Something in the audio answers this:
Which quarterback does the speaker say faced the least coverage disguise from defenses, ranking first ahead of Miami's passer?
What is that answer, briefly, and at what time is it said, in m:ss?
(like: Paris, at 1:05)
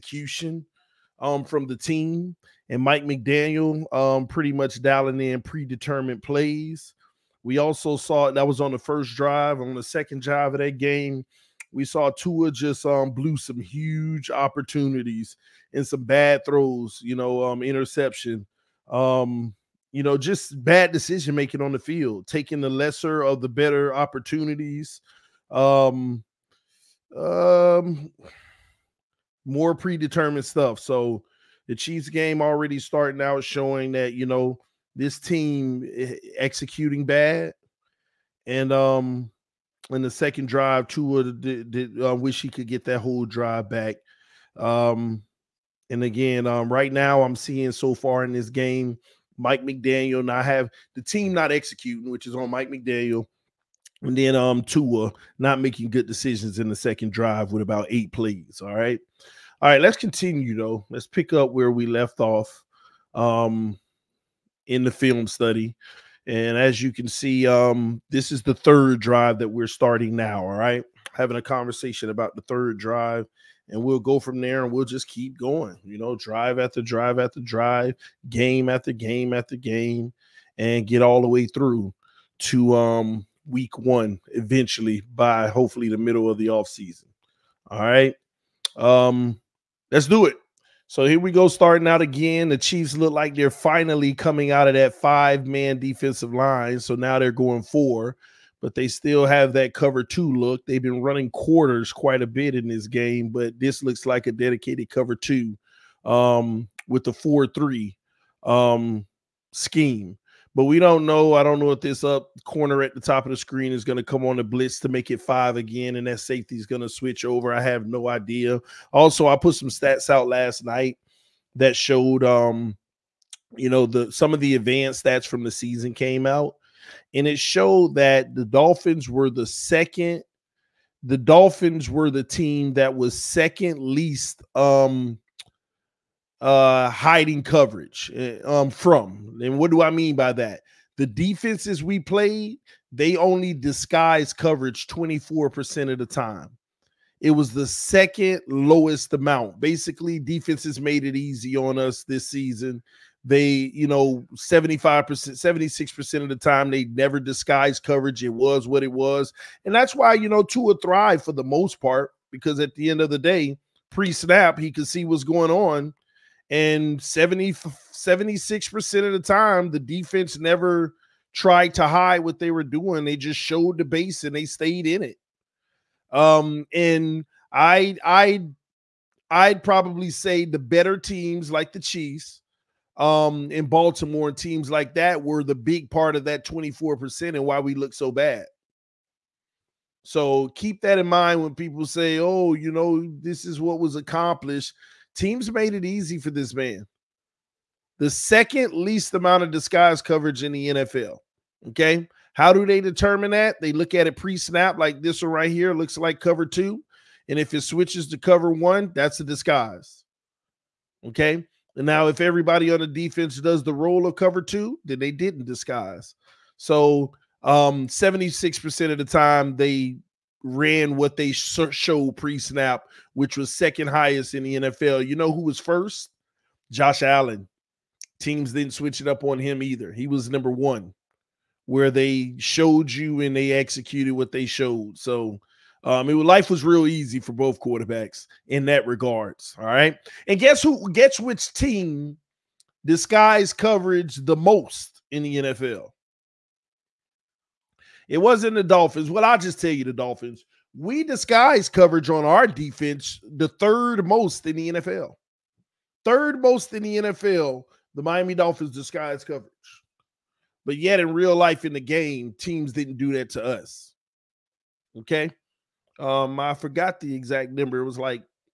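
Josh Allen, at 3:46.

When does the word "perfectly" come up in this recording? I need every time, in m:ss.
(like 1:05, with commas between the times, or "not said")
not said.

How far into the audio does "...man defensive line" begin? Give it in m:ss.
1:35.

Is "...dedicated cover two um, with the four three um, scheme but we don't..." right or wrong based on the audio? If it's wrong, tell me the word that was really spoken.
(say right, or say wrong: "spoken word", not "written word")
right.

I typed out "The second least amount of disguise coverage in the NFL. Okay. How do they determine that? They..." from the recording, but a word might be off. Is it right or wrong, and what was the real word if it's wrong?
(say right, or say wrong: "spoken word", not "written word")
right.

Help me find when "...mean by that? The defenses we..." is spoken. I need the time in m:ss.
2:19.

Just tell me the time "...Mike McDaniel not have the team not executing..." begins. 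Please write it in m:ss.
0:49.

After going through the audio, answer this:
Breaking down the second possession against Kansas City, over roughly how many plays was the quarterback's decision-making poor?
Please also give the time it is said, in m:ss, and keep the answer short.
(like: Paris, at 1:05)
8, at 0:57.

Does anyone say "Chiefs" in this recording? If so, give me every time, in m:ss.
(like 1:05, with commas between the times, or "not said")
0:31, 1:32, 3:01.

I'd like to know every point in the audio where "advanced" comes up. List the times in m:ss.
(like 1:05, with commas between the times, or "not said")
2:04.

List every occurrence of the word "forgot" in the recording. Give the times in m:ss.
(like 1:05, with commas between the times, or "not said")
4:26.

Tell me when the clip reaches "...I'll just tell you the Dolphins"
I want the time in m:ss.
4:09.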